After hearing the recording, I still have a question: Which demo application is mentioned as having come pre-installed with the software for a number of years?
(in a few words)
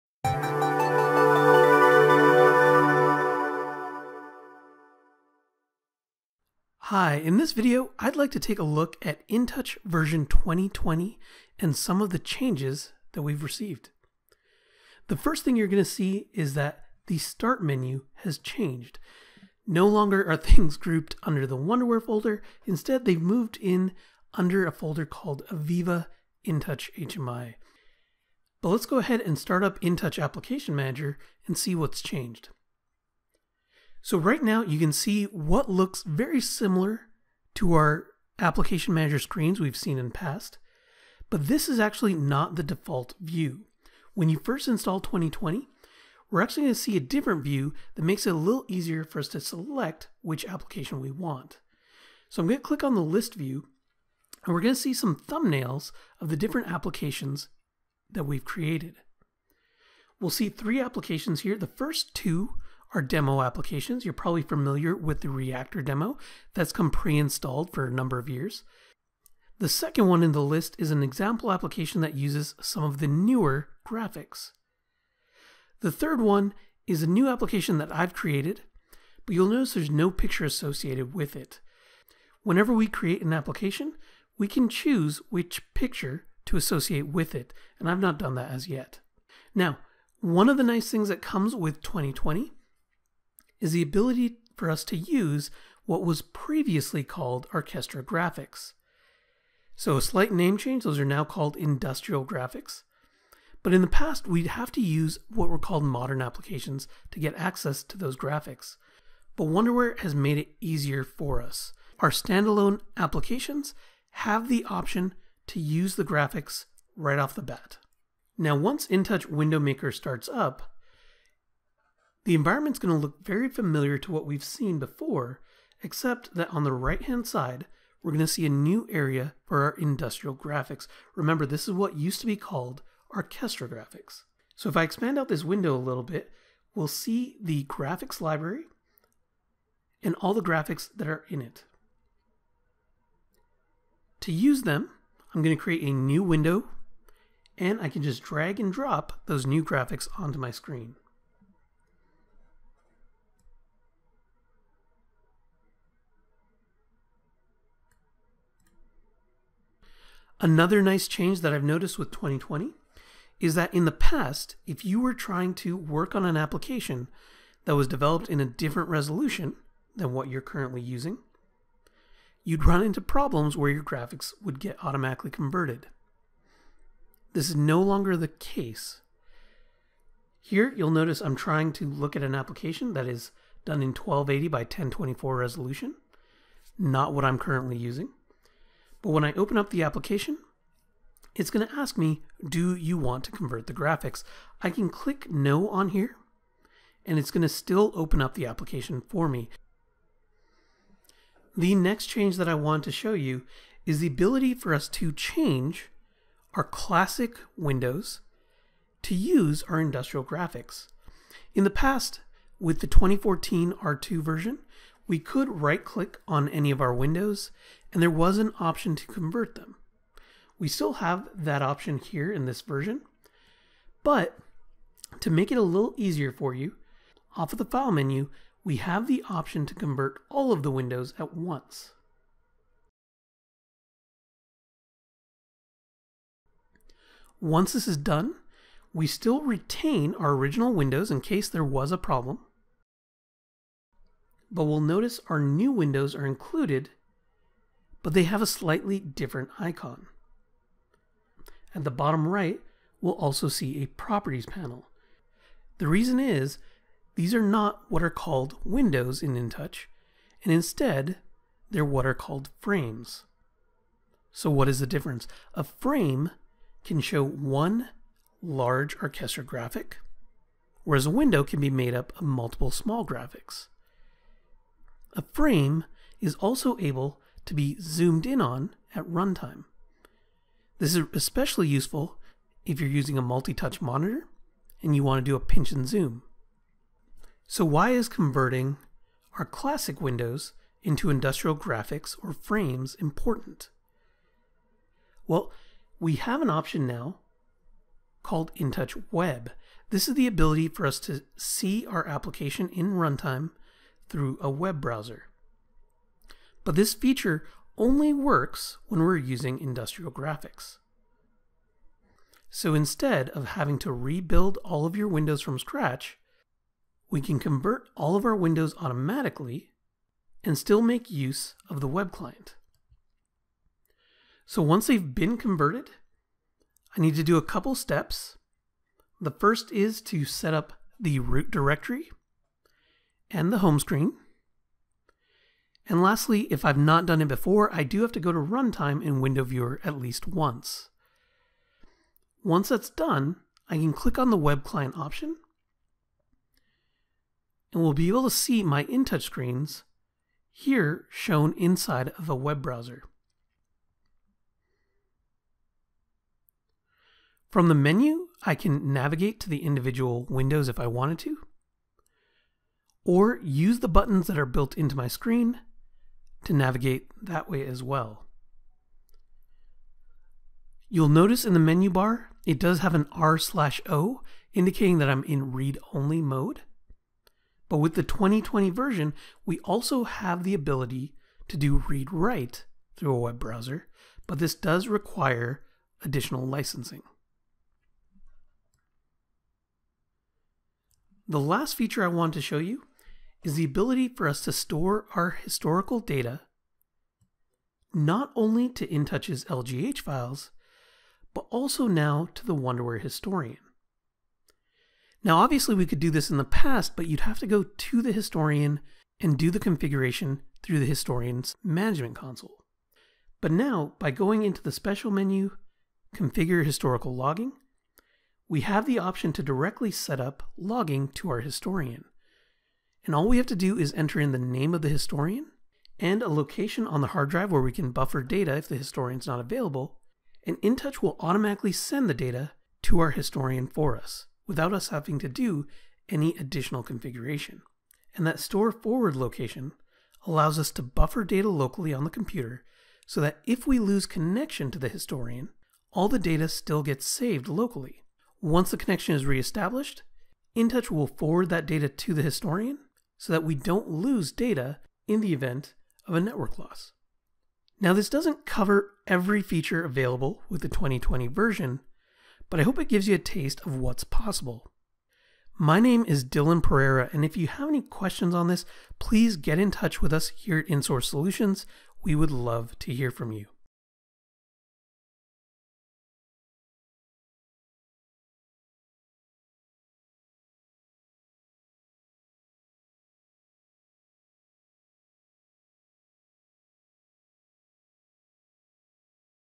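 Reactor demo.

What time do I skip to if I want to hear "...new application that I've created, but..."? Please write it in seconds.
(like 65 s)
77 s.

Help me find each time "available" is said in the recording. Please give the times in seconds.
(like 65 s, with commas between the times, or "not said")
429 s, 459 s.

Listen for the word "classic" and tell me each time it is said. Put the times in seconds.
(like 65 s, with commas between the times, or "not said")
206 s, 289 s.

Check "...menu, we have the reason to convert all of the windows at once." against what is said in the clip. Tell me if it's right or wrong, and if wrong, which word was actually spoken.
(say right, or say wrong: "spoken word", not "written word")
wrong: "option", not "reason".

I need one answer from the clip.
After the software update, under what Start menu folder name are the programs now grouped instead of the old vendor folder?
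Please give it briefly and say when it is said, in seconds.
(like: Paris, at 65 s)
AVEVA InTouch HMI, at 25 s.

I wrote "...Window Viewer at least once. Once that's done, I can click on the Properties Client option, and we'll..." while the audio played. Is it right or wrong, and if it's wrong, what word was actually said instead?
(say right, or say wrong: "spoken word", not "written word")
wrong: "Web", not "Properties".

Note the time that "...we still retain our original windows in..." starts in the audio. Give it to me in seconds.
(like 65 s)
238 s.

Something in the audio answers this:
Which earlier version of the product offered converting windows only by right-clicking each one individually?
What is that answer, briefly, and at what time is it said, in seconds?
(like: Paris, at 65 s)
2014 R2, at 212 s.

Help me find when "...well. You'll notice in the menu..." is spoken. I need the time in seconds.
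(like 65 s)
367 s.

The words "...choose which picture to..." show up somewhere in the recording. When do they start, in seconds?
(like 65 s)
84 s.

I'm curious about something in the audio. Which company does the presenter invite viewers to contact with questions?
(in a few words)
InSource Solutions.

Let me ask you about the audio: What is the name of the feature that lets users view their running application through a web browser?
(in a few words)
InTouch Web.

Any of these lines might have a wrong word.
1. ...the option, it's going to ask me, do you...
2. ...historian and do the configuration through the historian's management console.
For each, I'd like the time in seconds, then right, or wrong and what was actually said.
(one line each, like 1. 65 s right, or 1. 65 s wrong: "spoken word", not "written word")
1. 189 s wrong: "application", not "option"
2. 408 s right.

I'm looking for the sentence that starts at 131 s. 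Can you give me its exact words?
Remember, this is what used to be called Archestra graphics.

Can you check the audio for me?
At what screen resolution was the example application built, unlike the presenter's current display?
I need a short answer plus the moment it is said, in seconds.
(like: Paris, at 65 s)
1280 by 1024, at 183 s.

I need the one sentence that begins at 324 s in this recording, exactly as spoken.
So once they've been converted, I need to do a couple steps.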